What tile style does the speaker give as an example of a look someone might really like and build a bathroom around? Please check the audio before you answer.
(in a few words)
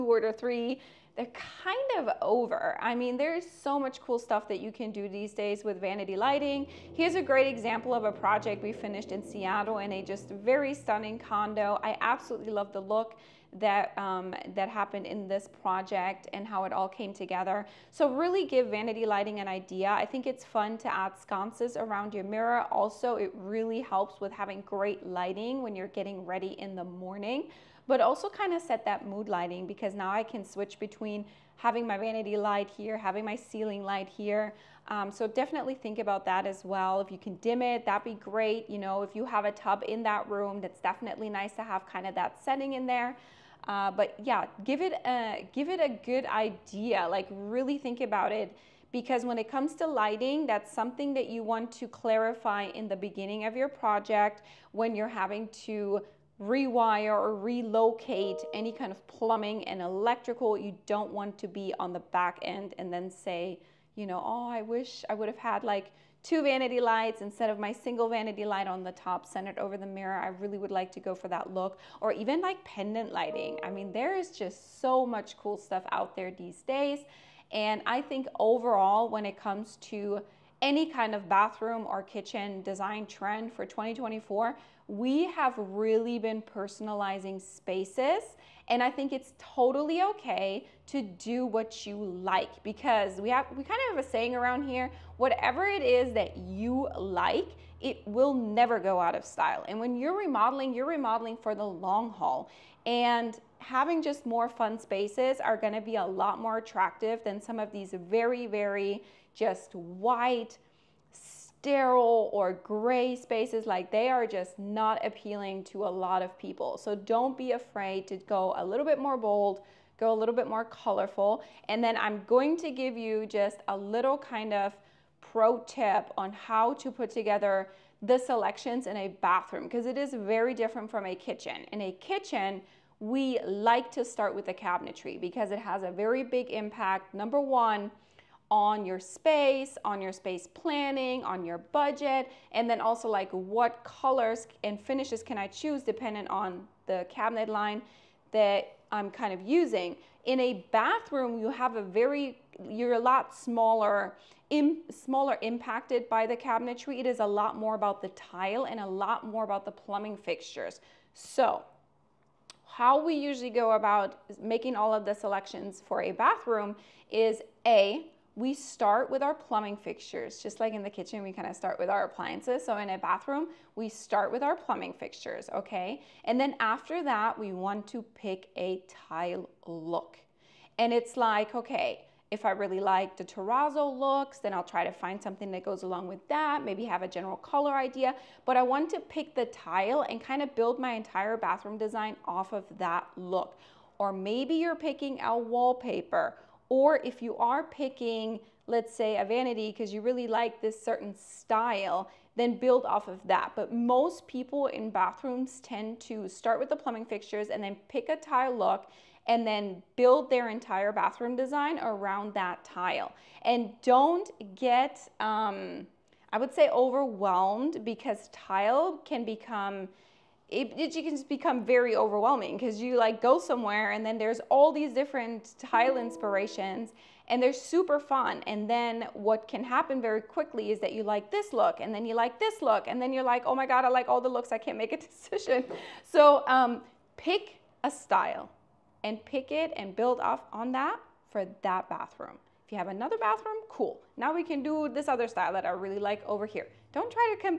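terrazzo.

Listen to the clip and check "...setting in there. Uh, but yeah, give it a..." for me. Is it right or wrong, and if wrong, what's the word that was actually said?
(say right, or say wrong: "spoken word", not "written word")
right.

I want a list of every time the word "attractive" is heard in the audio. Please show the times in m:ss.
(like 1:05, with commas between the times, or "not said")
1:46.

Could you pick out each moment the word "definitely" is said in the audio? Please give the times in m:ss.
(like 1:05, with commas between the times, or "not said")
0:35, 0:40.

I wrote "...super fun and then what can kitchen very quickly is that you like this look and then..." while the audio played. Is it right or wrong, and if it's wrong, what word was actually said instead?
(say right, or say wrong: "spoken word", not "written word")
wrong: "happen", not "kitchen".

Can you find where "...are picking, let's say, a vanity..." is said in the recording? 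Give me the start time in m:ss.
3:17.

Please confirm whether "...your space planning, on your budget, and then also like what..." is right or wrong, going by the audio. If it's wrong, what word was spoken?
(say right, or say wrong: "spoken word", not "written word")
right.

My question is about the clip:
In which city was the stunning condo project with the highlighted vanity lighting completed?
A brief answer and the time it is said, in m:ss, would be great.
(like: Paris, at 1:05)
Seattle, at 0:09.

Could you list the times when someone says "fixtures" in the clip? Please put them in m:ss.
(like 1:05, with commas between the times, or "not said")
2:40, 2:49, 2:54, 3:27.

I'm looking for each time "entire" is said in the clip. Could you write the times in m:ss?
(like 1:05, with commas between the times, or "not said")
3:10, 3:30.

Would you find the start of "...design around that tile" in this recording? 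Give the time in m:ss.
3:31.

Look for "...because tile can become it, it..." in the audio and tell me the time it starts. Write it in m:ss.
3:37.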